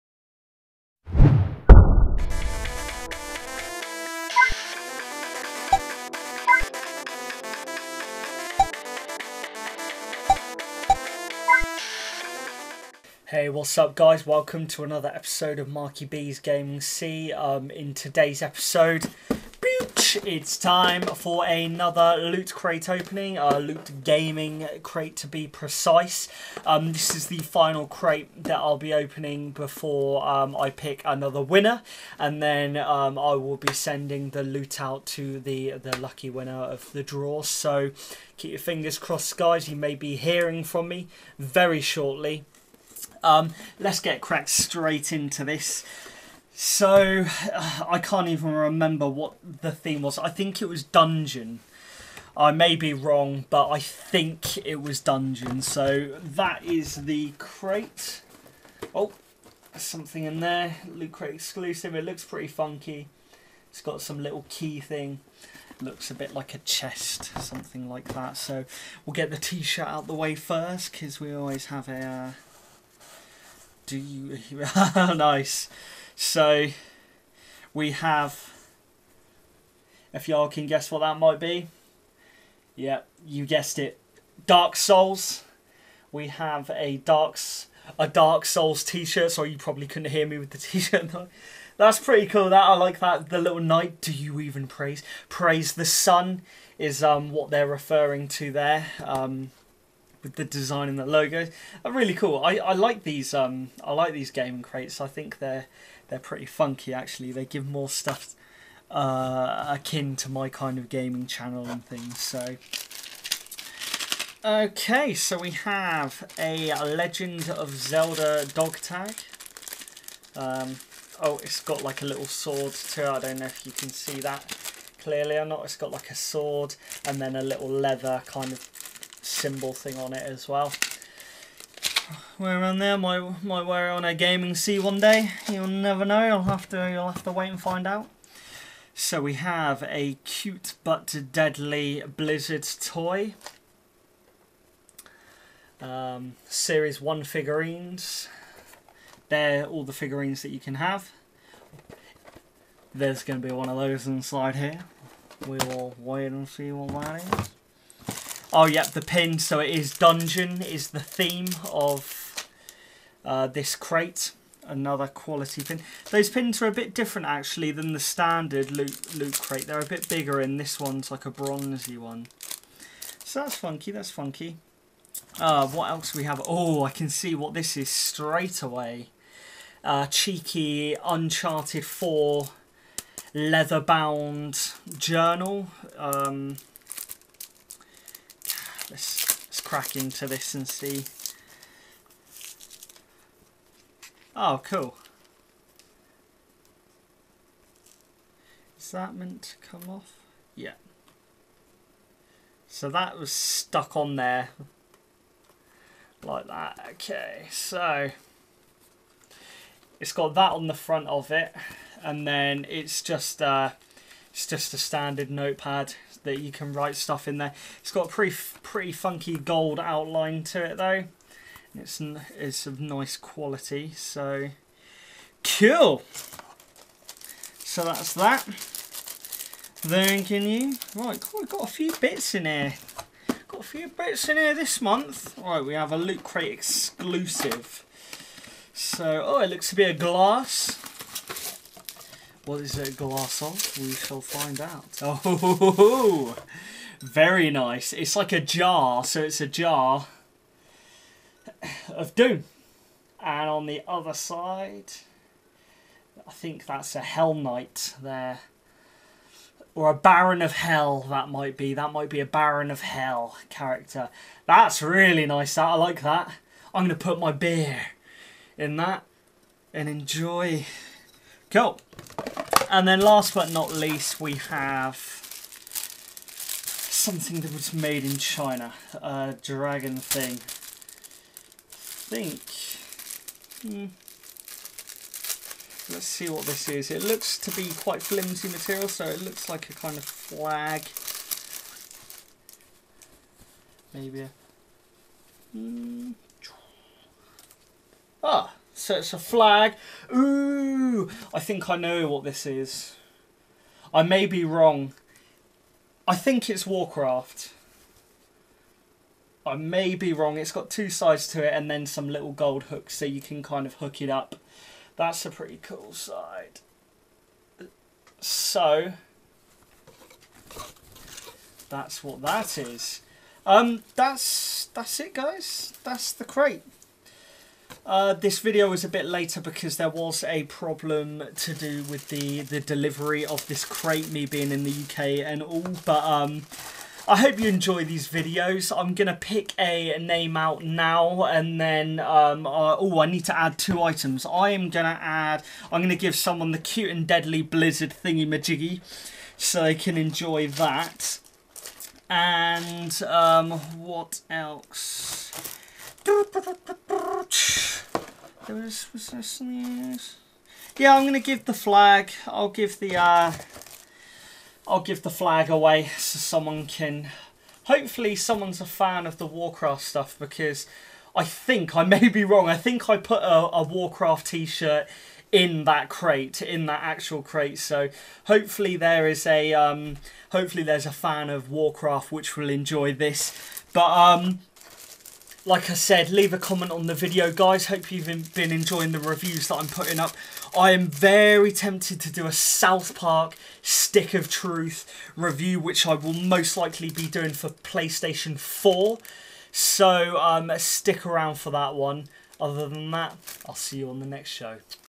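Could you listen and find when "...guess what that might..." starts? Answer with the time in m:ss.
1:20.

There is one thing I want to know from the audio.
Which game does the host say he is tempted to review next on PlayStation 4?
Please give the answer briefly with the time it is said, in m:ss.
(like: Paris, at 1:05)
South Park Stick of Truth, at 6:32.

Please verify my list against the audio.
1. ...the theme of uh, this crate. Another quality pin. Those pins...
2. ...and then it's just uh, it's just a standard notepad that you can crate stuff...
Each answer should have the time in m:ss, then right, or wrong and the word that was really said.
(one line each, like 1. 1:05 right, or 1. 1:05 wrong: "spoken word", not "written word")
1. 2:40 right
2. 3:32 wrong: "write", not "crate".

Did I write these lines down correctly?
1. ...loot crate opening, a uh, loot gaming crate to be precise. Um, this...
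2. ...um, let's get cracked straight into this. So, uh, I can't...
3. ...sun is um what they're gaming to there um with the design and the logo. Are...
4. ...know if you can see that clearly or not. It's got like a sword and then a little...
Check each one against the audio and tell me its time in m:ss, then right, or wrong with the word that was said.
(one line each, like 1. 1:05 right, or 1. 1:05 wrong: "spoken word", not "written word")
1. 0:22 right
2. 0:43 right
3. 1:35 wrong: "referring", not "gaming"
4. 2:03 right.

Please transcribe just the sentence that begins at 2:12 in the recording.
Wear on there, might, might wear it on a gaming C one day.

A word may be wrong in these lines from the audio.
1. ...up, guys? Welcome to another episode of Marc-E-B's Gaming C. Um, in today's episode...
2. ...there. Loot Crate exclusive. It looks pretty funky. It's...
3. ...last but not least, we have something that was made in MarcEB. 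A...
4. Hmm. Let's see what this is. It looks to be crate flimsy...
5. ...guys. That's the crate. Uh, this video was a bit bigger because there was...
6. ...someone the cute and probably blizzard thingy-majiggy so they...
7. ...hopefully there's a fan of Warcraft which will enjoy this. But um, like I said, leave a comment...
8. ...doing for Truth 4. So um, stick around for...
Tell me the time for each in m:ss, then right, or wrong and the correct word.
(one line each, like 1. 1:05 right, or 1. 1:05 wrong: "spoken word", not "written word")
1. 0:13 right
2. 1:00 right
3. 4:33 wrong: "China", not "MarcEB"
4. 4:43 wrong: "quite", not "crate"
5. 5:25 wrong: "later", not "bigger"
6. 5:46 wrong: "deadly", not "probably"
7. 6:20 right
8. 6:37 wrong: "PlayStation", not "Truth".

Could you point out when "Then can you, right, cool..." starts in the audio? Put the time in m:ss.
3:49.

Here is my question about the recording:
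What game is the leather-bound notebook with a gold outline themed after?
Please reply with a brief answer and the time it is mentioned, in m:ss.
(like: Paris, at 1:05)
Uncharted 4, at 3:01.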